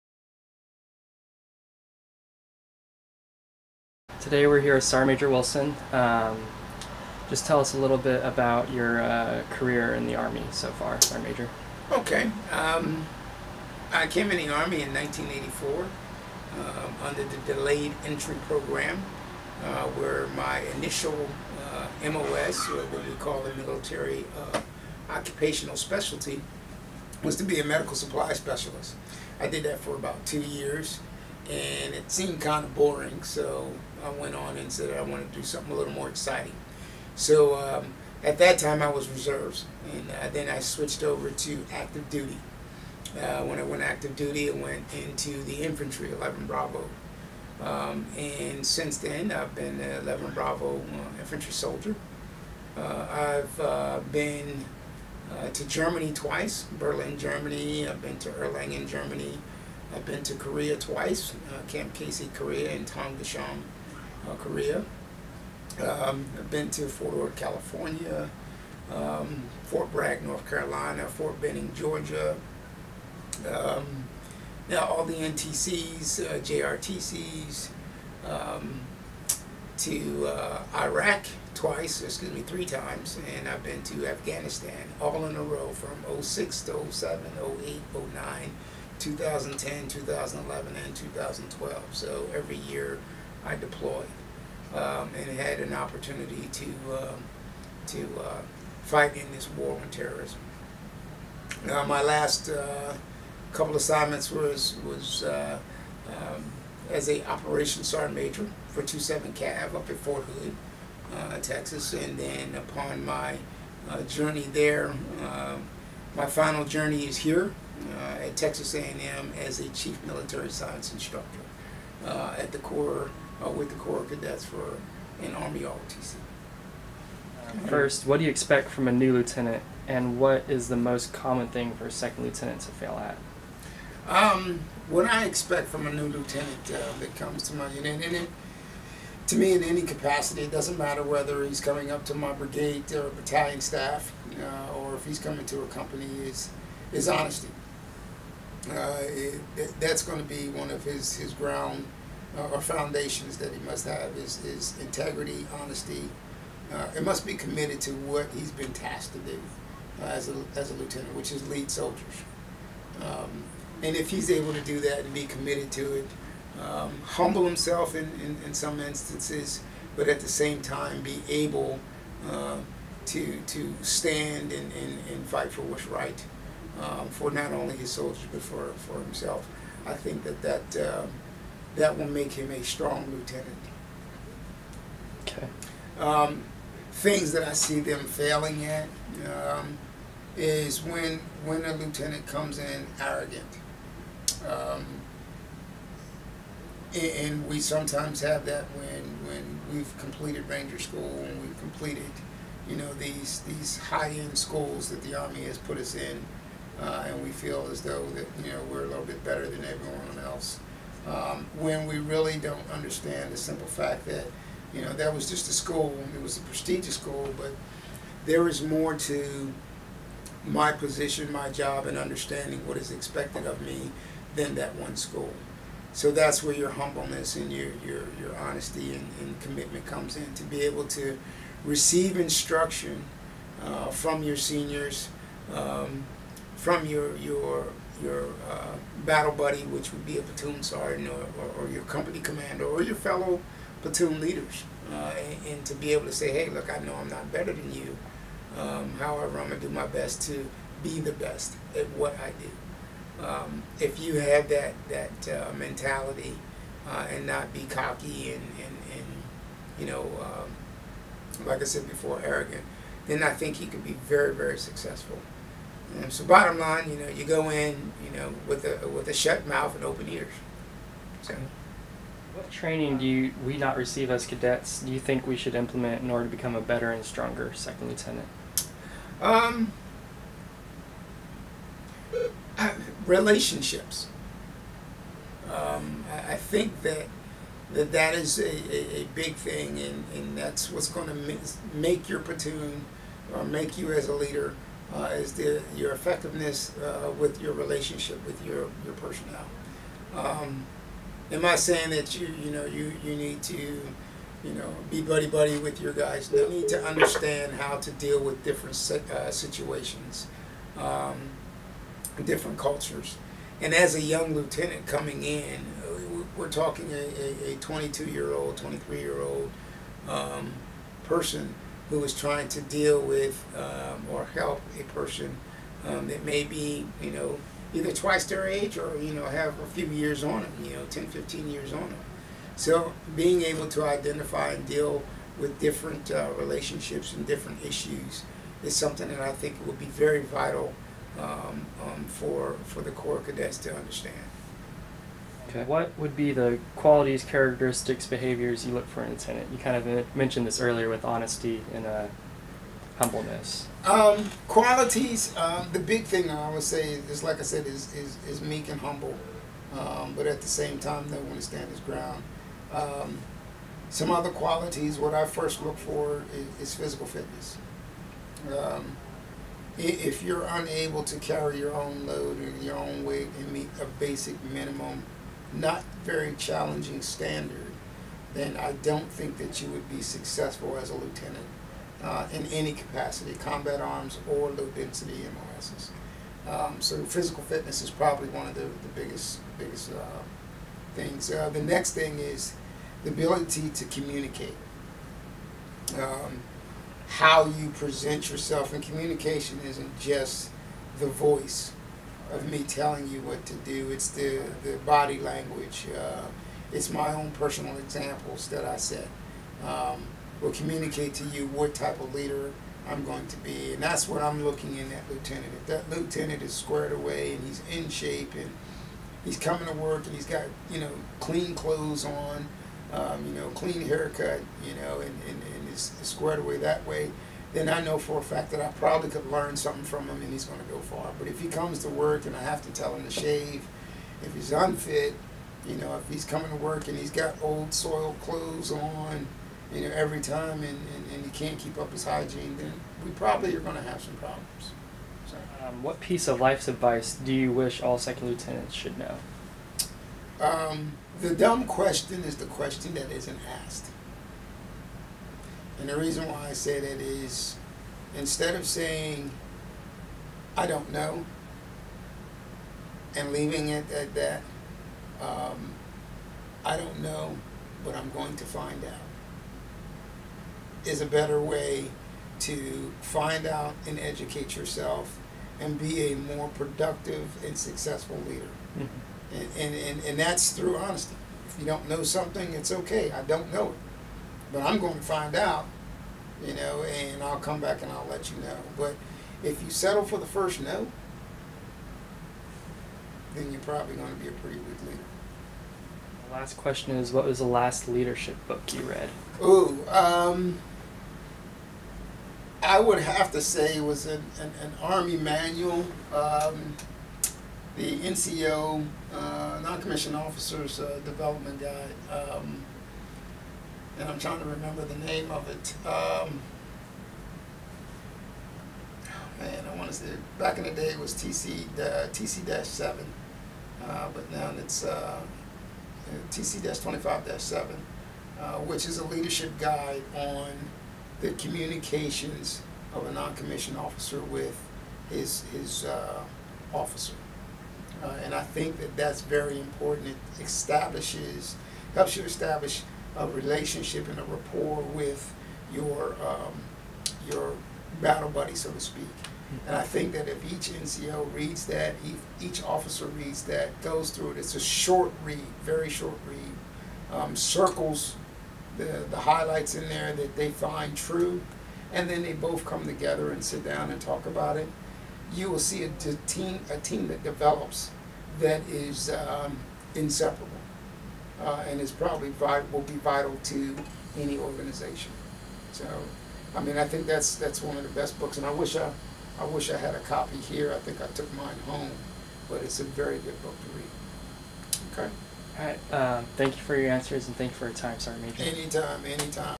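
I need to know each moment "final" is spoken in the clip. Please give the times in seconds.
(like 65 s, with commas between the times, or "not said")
116 s.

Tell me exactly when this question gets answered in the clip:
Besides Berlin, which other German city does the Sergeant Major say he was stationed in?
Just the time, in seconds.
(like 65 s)
58 s.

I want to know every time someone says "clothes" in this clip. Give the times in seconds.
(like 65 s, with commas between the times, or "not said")
421 s, 438 s.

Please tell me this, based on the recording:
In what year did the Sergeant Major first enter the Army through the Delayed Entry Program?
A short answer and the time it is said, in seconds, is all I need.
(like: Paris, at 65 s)
1984, at 14 s.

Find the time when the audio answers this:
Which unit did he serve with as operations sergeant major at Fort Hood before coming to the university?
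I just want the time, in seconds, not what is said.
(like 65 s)
108 s.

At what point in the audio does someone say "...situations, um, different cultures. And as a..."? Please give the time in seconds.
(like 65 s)
309 s.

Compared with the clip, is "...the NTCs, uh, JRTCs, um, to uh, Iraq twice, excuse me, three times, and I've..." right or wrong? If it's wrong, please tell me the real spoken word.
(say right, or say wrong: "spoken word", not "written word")
right.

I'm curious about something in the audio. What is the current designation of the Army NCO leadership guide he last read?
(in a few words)
TC 25-7.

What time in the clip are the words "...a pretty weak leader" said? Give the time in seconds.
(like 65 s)
494 s.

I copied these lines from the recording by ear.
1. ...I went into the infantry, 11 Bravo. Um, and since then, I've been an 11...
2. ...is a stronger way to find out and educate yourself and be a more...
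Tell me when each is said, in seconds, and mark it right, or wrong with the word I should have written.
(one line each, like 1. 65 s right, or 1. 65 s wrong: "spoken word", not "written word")
1. 44 s right
2. 470 s wrong: "better", not "stronger".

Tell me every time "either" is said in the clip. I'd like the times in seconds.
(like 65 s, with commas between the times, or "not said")
327 s.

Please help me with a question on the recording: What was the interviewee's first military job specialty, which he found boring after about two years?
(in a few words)
Medical supply specialist.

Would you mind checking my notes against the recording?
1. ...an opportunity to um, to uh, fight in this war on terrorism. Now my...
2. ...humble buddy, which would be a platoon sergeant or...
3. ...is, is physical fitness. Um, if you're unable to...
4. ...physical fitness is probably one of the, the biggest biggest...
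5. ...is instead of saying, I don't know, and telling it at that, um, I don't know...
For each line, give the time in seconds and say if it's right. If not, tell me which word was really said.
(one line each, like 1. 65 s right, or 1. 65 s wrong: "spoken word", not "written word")
1. 95 s right
2. 239 s wrong: "battle", not "humble"
3. 366 s right
4. 387 s right
5. 457 s wrong: "leaving", not "telling".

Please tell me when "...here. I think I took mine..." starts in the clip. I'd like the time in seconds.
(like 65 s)
580 s.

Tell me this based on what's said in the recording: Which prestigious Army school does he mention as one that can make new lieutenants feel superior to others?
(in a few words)
Ranger School.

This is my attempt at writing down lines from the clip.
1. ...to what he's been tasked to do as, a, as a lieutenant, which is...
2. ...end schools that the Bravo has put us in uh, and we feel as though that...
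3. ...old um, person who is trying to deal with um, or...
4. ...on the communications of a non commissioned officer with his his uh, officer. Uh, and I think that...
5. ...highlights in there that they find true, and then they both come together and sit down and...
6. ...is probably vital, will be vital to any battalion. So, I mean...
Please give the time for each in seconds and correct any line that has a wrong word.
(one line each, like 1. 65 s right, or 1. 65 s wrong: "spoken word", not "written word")
1. 157 s right
2. 204 s wrong: "Army", not "Bravo"
3. 319 s right
4. 530 s right
5. 559 s right
6. 571 s wrong: "organization", not "battalion".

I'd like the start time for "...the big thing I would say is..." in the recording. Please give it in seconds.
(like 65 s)
355 s.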